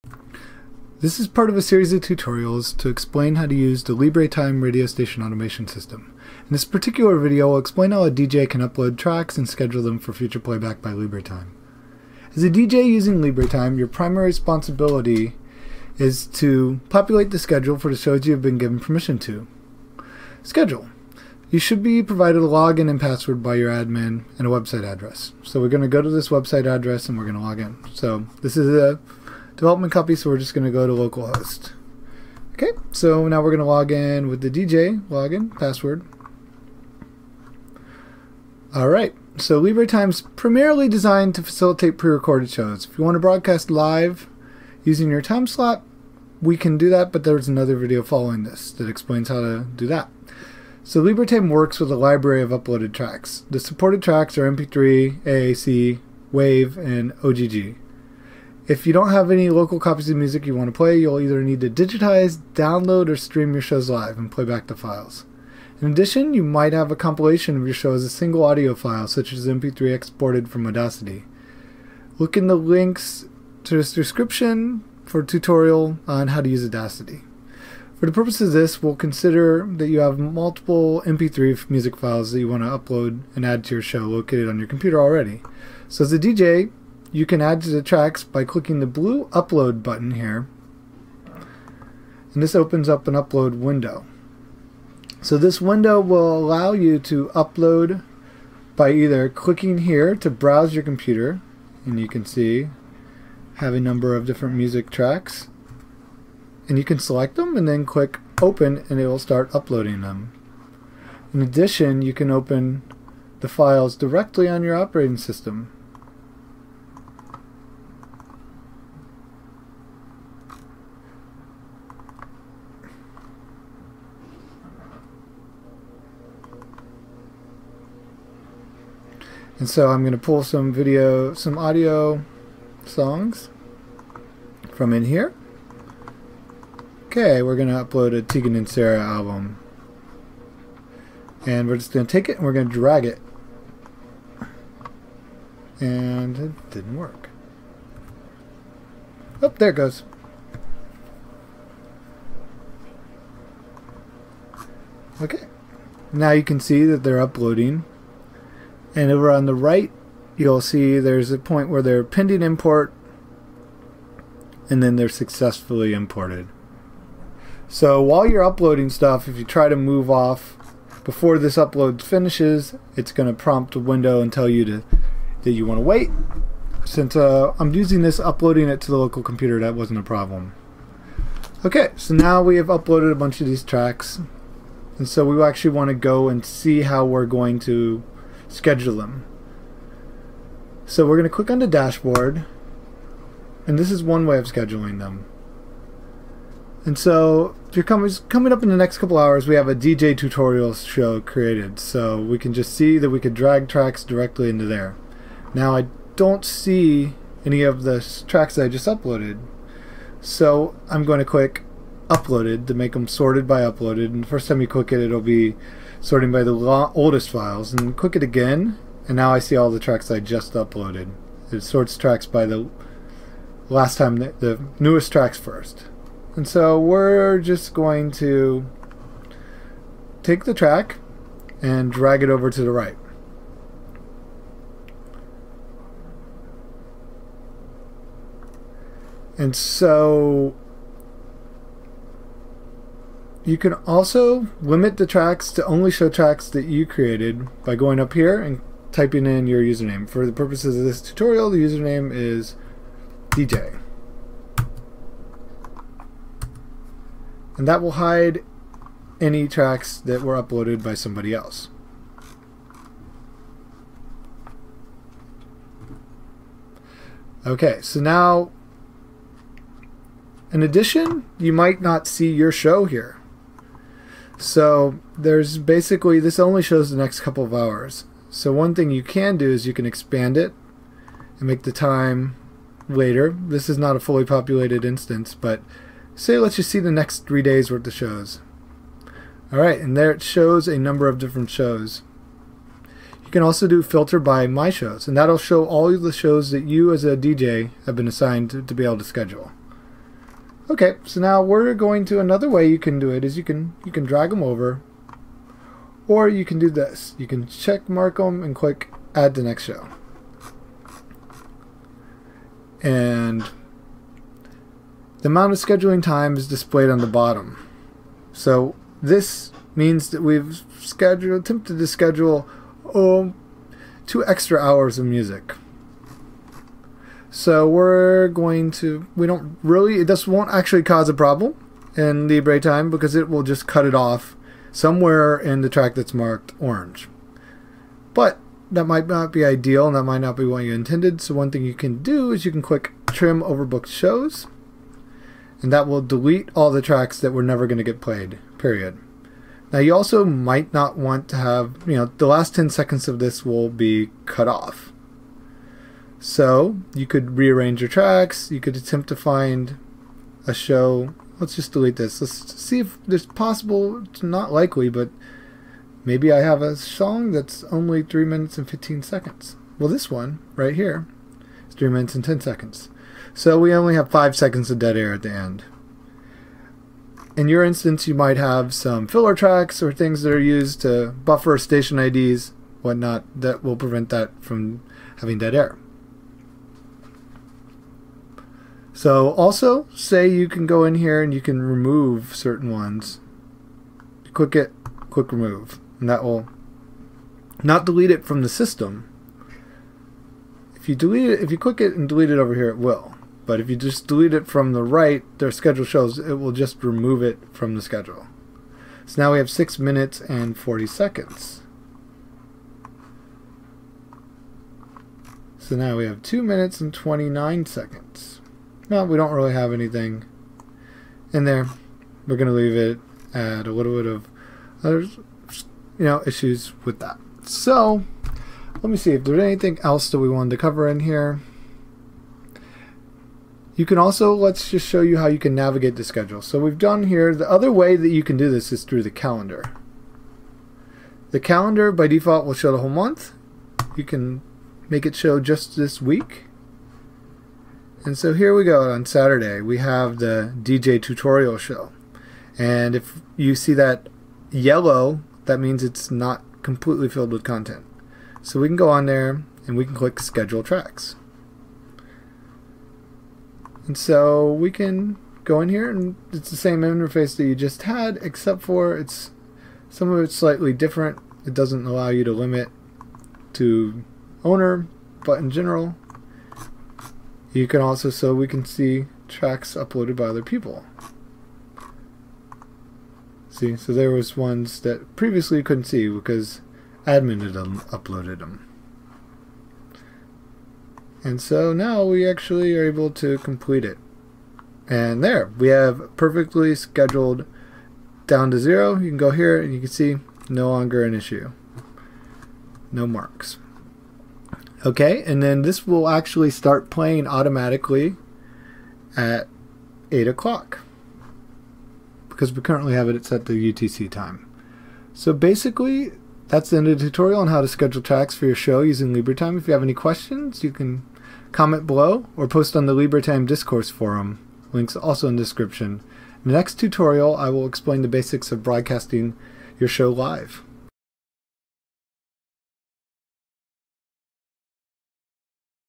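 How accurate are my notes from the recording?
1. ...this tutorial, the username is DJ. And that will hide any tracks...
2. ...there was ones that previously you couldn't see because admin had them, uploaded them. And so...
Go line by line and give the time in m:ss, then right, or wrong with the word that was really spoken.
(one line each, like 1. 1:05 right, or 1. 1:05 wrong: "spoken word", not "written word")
1. 4:10 right
2. 8:03 right.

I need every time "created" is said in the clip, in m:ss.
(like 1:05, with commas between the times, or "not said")
3:21, 4:06.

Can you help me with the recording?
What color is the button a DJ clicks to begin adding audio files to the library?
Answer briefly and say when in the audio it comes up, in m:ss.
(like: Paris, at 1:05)
Blue, at 1:28.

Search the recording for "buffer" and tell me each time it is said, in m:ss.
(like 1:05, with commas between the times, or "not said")
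6:21.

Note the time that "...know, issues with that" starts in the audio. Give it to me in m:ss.
7:05.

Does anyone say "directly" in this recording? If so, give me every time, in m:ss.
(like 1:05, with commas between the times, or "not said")
1:53, 3:24.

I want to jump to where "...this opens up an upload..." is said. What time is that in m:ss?
1:32.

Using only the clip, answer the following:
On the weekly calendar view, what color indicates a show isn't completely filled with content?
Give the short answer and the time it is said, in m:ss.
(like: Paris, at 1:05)
Yellow, at 7:34.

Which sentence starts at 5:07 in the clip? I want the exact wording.
You can check mark them and click add to next show.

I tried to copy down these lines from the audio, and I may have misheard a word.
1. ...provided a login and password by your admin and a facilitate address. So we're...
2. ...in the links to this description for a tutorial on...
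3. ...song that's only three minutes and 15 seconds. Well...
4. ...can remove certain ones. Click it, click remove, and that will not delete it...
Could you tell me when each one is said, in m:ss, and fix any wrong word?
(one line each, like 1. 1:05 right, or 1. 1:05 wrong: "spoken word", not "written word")
1. 0:22 wrong: "website", not "facilitate"
2. 1:12 right
3. 6:06 right
4. 6:31 right.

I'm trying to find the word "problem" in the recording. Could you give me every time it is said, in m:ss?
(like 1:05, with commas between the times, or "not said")
3:00, 5:31.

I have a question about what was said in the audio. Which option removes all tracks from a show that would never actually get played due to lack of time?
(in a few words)
Trim overbooked shows.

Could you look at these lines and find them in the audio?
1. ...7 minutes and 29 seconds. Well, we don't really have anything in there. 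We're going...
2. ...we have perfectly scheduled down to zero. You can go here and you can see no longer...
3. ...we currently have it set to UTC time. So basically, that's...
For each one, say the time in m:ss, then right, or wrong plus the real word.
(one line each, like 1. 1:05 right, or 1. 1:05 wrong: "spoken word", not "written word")
1. 6:56 wrong: "2", not "7"
2. 8:15 right
3. 8:32 right.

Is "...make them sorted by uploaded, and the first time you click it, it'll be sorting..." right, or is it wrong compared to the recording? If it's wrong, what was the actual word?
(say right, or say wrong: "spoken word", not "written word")
right.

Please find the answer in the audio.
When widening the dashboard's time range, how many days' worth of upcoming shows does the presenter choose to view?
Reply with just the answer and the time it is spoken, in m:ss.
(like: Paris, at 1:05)
3, at 4:47.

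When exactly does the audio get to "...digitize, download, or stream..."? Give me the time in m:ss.
1:01.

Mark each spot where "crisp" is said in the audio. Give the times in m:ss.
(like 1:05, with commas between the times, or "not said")
not said.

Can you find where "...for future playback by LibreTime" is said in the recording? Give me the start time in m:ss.
0:09.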